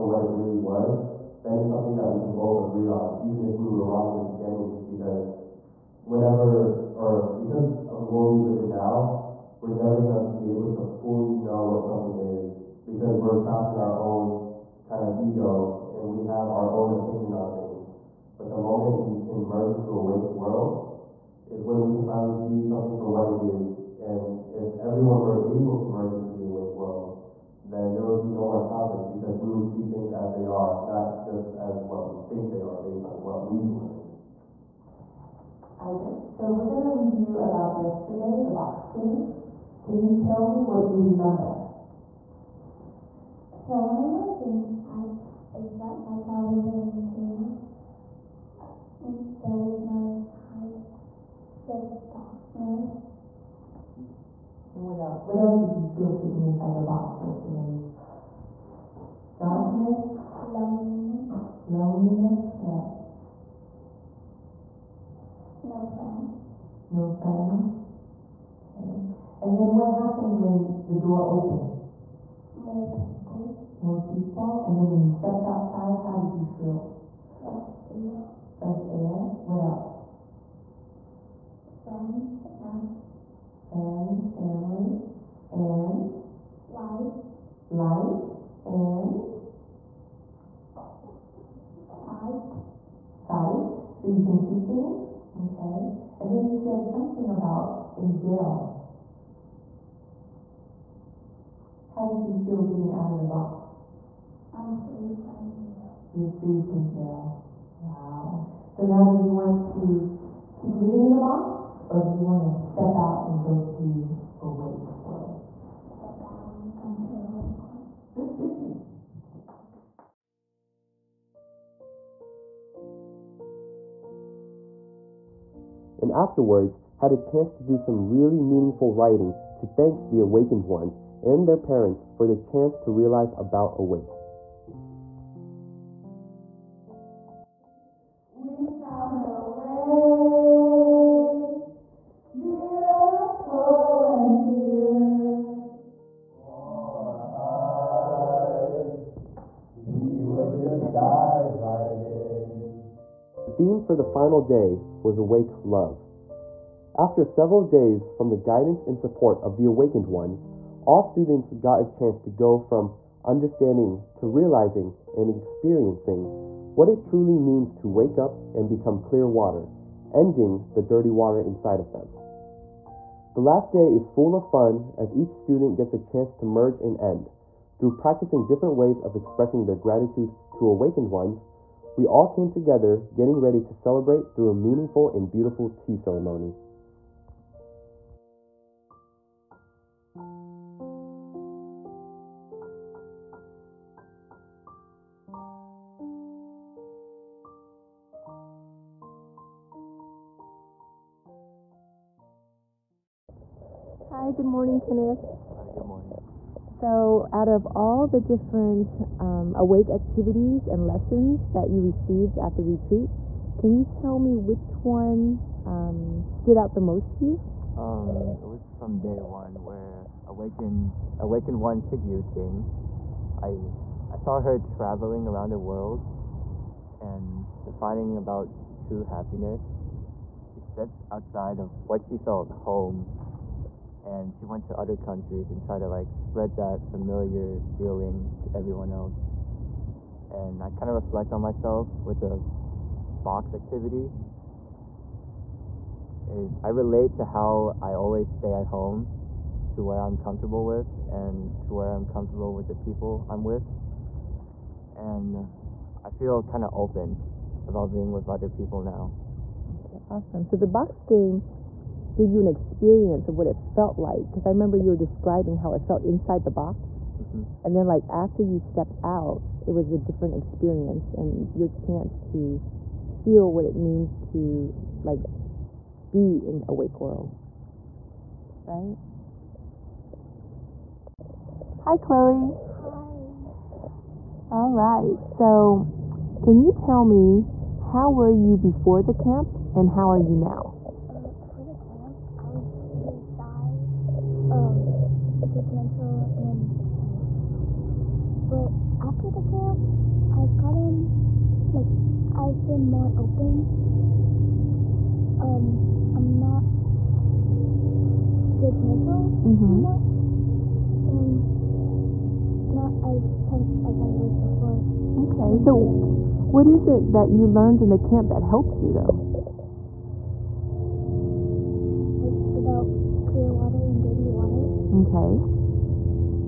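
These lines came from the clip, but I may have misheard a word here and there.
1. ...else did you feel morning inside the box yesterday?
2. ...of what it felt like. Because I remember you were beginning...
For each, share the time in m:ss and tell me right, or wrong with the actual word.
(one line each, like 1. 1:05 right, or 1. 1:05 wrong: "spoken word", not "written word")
1. 0:55 wrong: "sitting", not "morning"
2. 4:23 wrong: "describing", not "beginning".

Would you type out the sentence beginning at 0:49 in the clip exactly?
there was no sign, just darkness.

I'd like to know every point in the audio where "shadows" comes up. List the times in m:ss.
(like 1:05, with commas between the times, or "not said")
not said.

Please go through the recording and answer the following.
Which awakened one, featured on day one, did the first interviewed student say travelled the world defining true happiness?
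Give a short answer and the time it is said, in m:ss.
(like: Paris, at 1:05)
Tig Yu Ting, at 3:41.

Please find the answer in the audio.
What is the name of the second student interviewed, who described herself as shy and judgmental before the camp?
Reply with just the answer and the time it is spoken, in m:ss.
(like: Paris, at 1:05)
Chloe, at 4:41.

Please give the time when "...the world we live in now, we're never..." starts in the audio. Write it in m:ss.
0:08.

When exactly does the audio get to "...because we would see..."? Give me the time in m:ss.
0:29.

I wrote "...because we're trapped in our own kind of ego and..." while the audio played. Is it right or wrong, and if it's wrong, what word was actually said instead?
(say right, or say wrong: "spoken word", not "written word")
right.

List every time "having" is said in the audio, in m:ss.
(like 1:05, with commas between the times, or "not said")
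not said.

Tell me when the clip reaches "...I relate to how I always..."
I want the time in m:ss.
4:06.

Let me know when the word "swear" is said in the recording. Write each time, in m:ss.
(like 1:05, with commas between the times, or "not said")
not said.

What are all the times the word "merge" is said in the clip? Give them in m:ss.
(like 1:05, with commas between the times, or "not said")
0:19, 0:25, 2:56.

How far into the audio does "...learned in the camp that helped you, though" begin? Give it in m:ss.
5:17.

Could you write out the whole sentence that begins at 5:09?
anymore, and not as tense as I was before.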